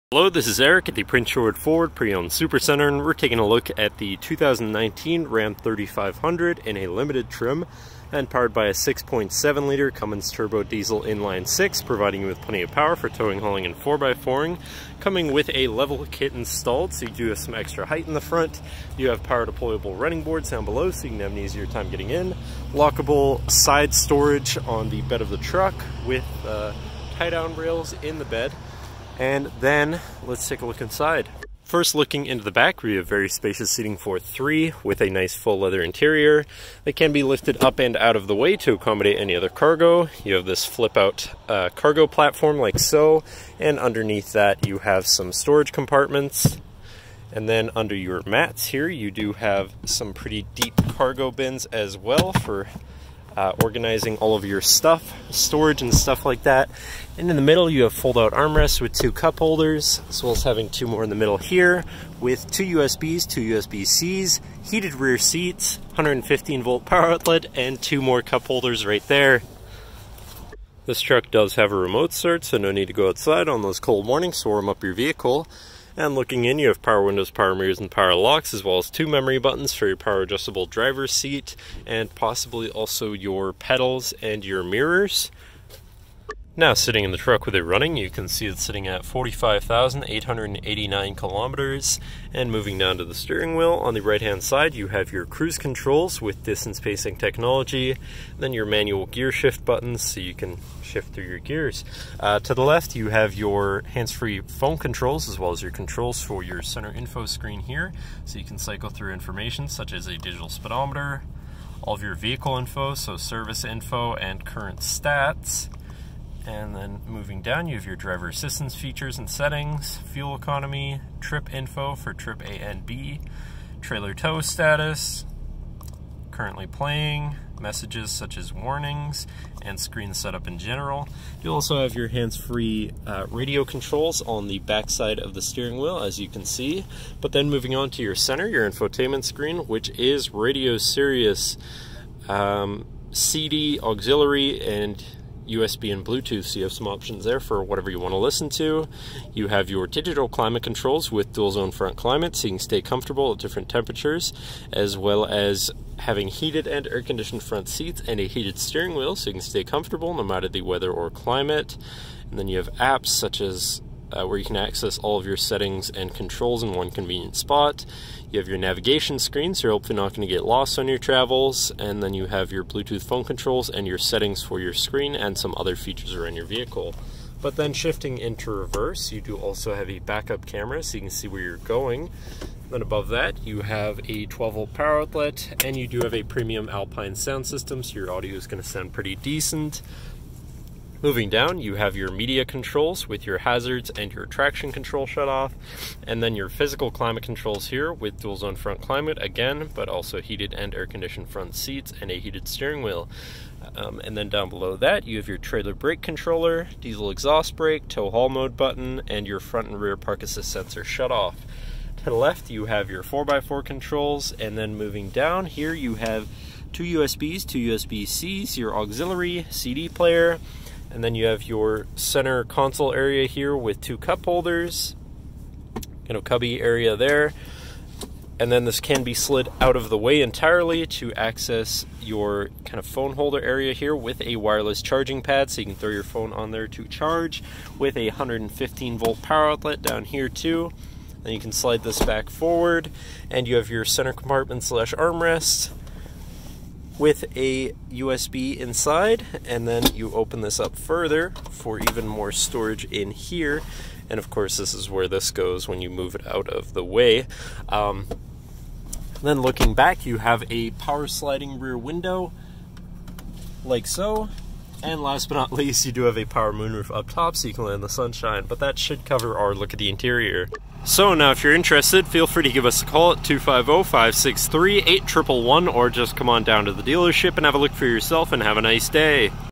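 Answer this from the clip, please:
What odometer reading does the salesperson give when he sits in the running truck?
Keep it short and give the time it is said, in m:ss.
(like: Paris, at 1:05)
45,889 kilometers, at 1:29.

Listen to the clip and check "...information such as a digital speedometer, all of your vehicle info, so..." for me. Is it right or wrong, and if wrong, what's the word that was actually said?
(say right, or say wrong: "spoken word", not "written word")
right.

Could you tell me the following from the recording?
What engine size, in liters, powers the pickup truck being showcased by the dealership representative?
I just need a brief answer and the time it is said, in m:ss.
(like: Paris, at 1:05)
6.7 liters, at 0:08.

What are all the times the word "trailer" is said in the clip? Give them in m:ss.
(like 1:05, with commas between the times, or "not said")
2:03, 3:25.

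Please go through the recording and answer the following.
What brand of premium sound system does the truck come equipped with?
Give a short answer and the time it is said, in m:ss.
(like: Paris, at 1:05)
Alpine, at 3:06.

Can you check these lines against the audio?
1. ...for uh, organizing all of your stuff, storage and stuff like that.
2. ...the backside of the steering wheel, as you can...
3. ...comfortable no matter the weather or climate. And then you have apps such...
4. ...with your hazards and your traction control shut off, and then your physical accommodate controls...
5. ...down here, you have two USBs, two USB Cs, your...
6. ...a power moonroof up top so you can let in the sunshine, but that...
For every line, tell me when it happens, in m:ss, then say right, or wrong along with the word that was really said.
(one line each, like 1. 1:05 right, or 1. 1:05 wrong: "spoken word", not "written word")
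1. 0:52 right
2. 2:14 right
3. 2:39 right
4. 3:13 wrong: "climate", not "accommodate"
5. 3:35 right
6. 4:26 right.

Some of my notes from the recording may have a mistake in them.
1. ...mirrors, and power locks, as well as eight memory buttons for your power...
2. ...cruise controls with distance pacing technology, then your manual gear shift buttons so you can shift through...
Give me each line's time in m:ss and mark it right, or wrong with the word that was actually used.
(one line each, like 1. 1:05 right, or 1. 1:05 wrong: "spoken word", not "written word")
1. 1:17 wrong: "two", not "eight"
2. 1:35 right.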